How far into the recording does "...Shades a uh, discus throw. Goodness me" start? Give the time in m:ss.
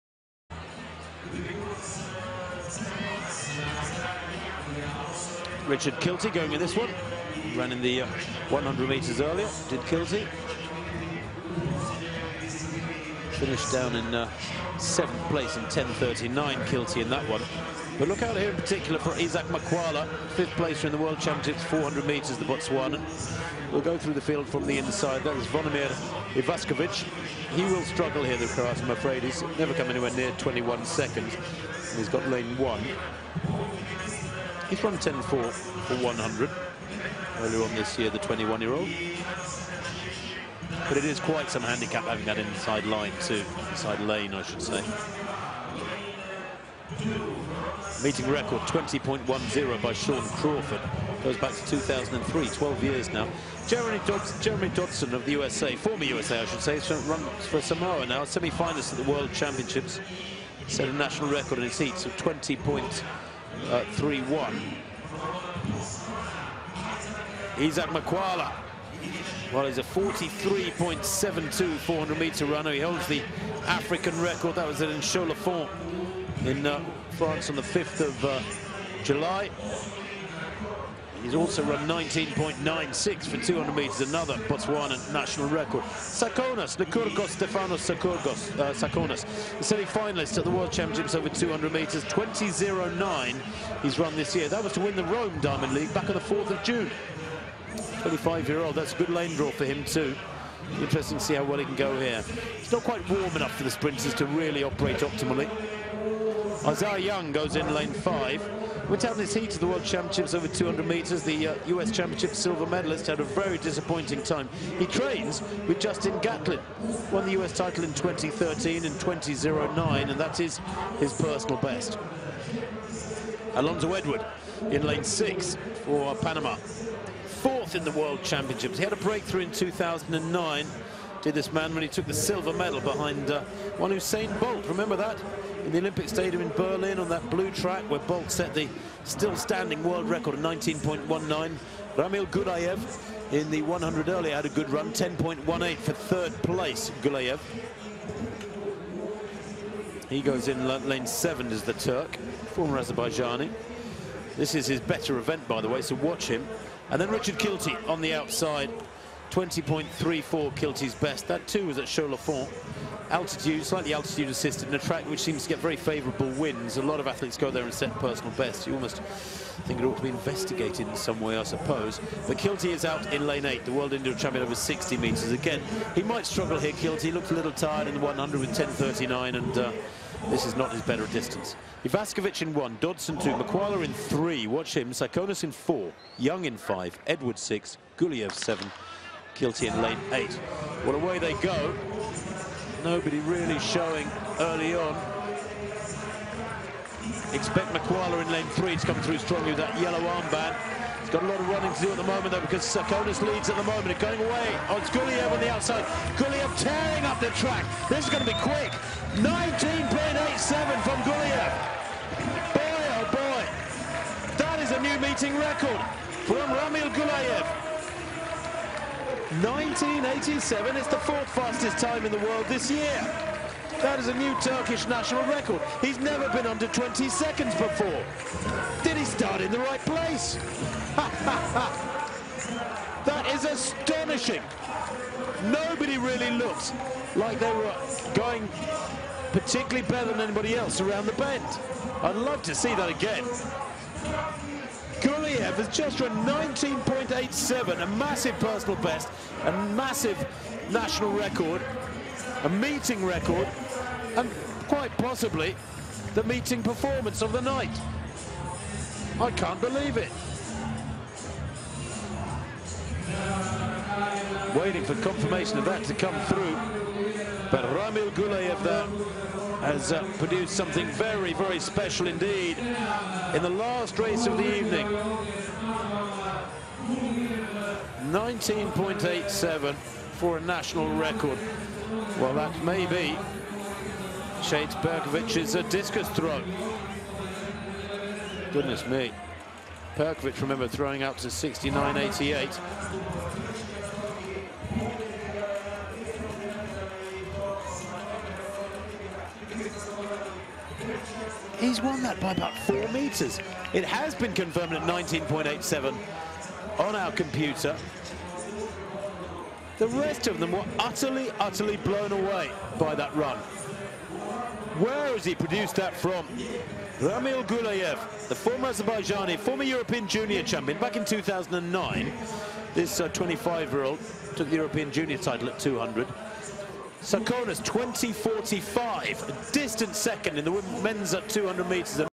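4:44.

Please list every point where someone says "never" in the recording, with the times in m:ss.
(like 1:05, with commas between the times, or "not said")
0:29, 3:45.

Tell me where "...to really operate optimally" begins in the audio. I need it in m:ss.
1:44.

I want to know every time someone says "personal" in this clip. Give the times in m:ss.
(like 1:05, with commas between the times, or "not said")
2:01, 2:47, 4:08.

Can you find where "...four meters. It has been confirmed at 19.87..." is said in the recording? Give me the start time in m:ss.
5:02.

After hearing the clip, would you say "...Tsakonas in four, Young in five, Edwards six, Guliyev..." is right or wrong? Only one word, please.
right.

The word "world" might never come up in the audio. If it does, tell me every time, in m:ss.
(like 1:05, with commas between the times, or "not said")
0:20, 0:59, 1:30, 1:49, 2:07, 2:19, 2:53, 3:42.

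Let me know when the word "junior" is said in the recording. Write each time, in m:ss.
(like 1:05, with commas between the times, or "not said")
5:20, 5:24.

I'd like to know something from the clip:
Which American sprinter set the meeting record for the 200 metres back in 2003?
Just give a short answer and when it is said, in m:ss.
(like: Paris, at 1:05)
Shawn Crawford, at 0:49.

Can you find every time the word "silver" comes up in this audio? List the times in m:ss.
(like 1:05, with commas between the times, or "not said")
1:52, 2:12.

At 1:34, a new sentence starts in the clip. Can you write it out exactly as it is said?
That was to win the Rome Diamond League back on the 4th of June.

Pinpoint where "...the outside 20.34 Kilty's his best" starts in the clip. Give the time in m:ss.
2:38.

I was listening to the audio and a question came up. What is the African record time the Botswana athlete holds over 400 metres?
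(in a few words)
43.72.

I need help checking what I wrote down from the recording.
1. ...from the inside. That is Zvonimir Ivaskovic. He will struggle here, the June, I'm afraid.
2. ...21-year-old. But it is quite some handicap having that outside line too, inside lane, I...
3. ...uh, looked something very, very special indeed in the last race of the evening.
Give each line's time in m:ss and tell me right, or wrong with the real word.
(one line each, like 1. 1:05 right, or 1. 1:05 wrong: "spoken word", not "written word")
1. 0:24 wrong: "Croat", not "June"
2. 0:38 wrong: "inside", not "outside"
3. 4:29 wrong: "produced", not "looked".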